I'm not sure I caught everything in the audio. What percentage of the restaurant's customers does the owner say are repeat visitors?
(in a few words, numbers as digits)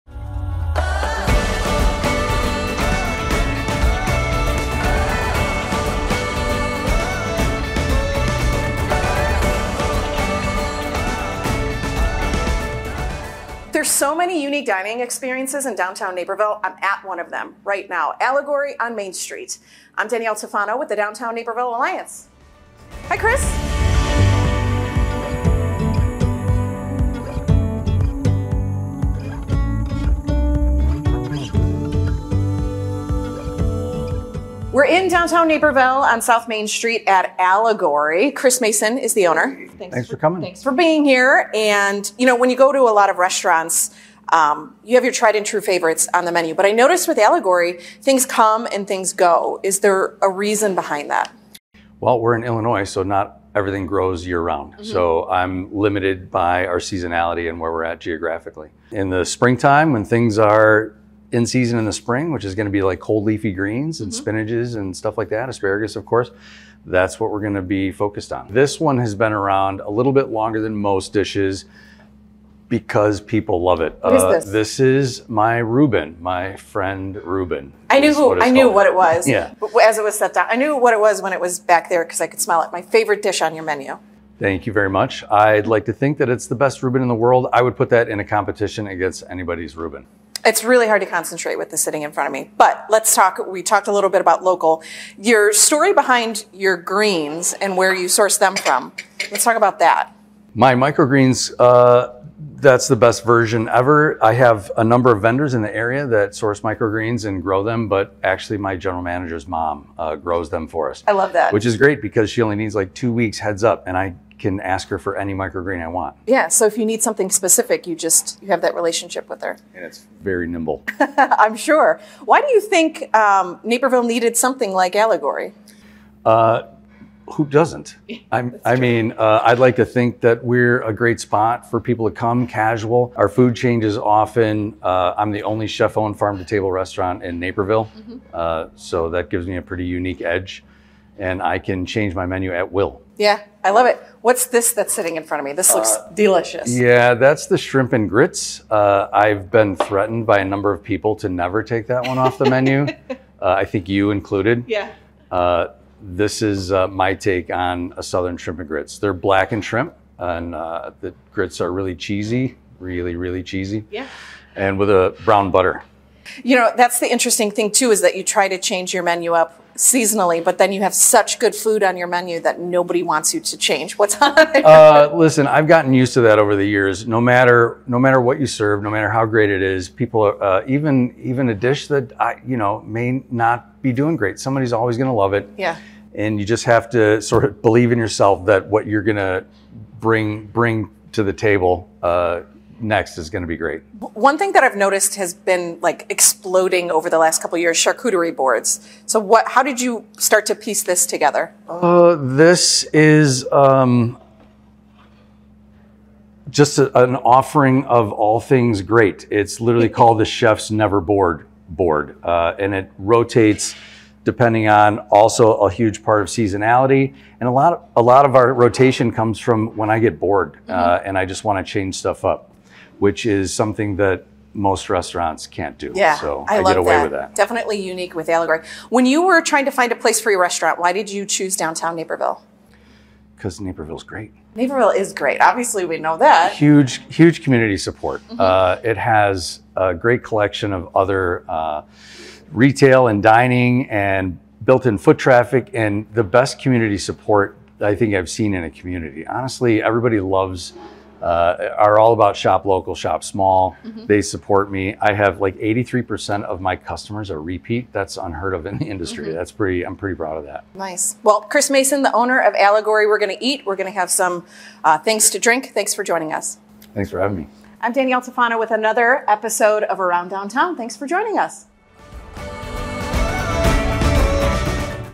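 83%.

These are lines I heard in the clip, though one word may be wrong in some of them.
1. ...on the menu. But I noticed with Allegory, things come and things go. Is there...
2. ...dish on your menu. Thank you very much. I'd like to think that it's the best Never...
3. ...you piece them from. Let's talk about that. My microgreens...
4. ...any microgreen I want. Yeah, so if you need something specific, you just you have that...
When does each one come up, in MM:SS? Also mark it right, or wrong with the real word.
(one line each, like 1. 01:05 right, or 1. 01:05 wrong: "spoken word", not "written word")
1. 00:46 right
2. 01:23 wrong: "Reuben", not "Never"
3. 01:37 wrong: "source", not "piece"
4. 01:55 right.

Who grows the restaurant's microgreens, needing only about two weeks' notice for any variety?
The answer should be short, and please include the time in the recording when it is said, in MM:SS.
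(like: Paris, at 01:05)
General manager's mom, at 01:48.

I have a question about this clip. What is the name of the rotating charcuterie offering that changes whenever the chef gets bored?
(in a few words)
Chef's Never Bored board.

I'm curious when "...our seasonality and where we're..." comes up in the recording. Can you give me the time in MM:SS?
00:56.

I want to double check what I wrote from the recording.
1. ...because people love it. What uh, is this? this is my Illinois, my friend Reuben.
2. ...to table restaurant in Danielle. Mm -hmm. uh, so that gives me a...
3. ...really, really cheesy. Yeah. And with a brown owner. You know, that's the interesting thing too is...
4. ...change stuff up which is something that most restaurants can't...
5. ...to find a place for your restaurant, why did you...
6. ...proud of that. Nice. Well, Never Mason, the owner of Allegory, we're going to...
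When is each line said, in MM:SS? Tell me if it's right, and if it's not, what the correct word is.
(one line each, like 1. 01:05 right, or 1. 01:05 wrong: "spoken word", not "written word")
1. 01:12 wrong: "Reuben", not "Illinois"
2. 02:16 wrong: "Naperville", not "Danielle"
3. 02:42 wrong: "butter", not "owner"
4. 03:41 right
5. 03:49 right
6. 04:20 wrong: "Chris", not "Never".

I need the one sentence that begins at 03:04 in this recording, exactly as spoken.
Somebody's always going to love it.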